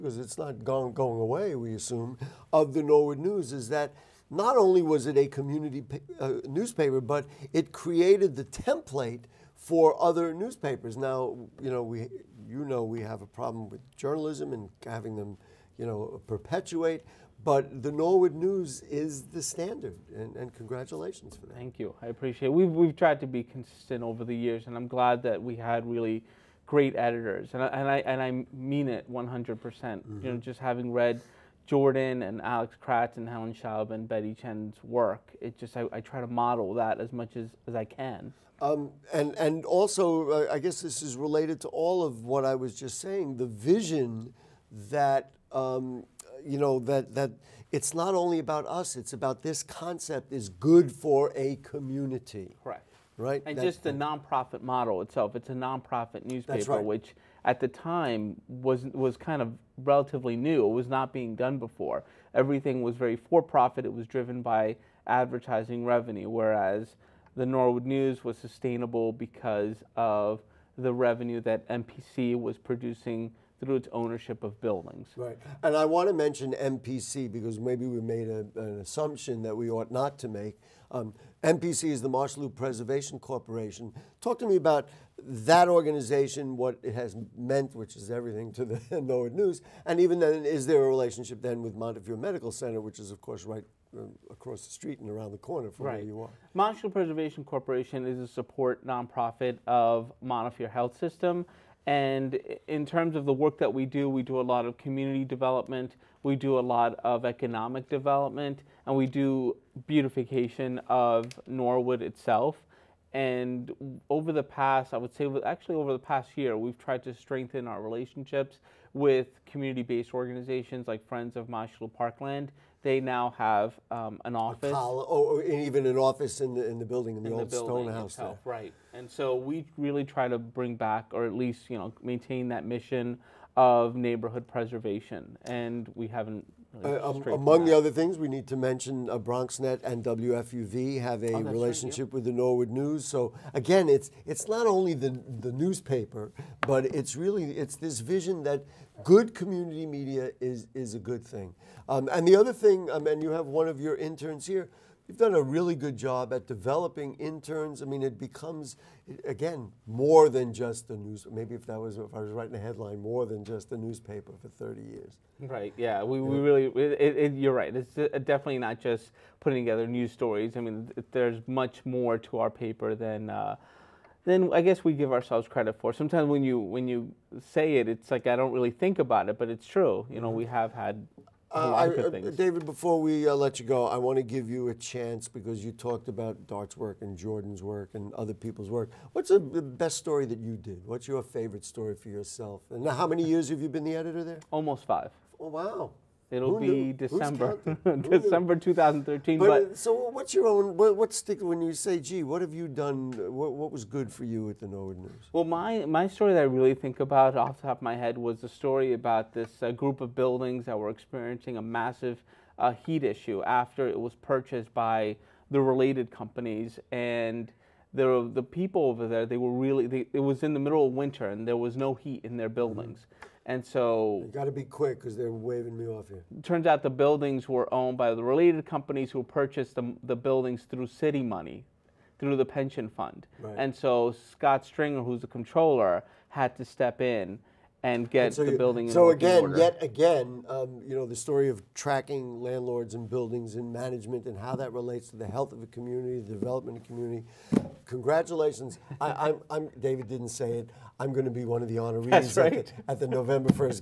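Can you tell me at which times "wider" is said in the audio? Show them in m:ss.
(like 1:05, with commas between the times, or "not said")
not said.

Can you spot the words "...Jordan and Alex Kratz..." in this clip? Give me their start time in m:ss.
0:31.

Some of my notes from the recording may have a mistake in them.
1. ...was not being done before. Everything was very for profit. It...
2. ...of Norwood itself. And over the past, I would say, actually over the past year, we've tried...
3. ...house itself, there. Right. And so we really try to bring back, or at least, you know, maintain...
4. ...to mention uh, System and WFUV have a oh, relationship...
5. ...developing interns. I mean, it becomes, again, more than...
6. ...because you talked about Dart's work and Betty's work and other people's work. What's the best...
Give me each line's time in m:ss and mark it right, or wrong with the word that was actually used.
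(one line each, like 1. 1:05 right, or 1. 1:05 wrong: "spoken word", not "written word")
1. 1:00 right
2. 1:50 right
3. 2:07 right
4. 2:18 wrong: "BronxNet", not "System"
5. 2:36 right
6. 3:05 wrong: "Jordan", not "Betty".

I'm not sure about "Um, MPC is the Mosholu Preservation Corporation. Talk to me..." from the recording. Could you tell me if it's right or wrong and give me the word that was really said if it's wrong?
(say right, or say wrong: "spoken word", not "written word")
right.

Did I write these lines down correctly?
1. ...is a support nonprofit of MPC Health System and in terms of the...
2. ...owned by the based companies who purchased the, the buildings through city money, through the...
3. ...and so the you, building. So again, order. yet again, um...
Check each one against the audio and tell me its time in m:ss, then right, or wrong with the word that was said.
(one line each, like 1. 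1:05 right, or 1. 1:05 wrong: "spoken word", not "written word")
1. 1:38 wrong: "Montefiore", not "MPC"
2. 3:47 wrong: "related", not "based"
3. 3:58 right.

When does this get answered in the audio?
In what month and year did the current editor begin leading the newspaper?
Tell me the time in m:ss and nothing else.
3:18.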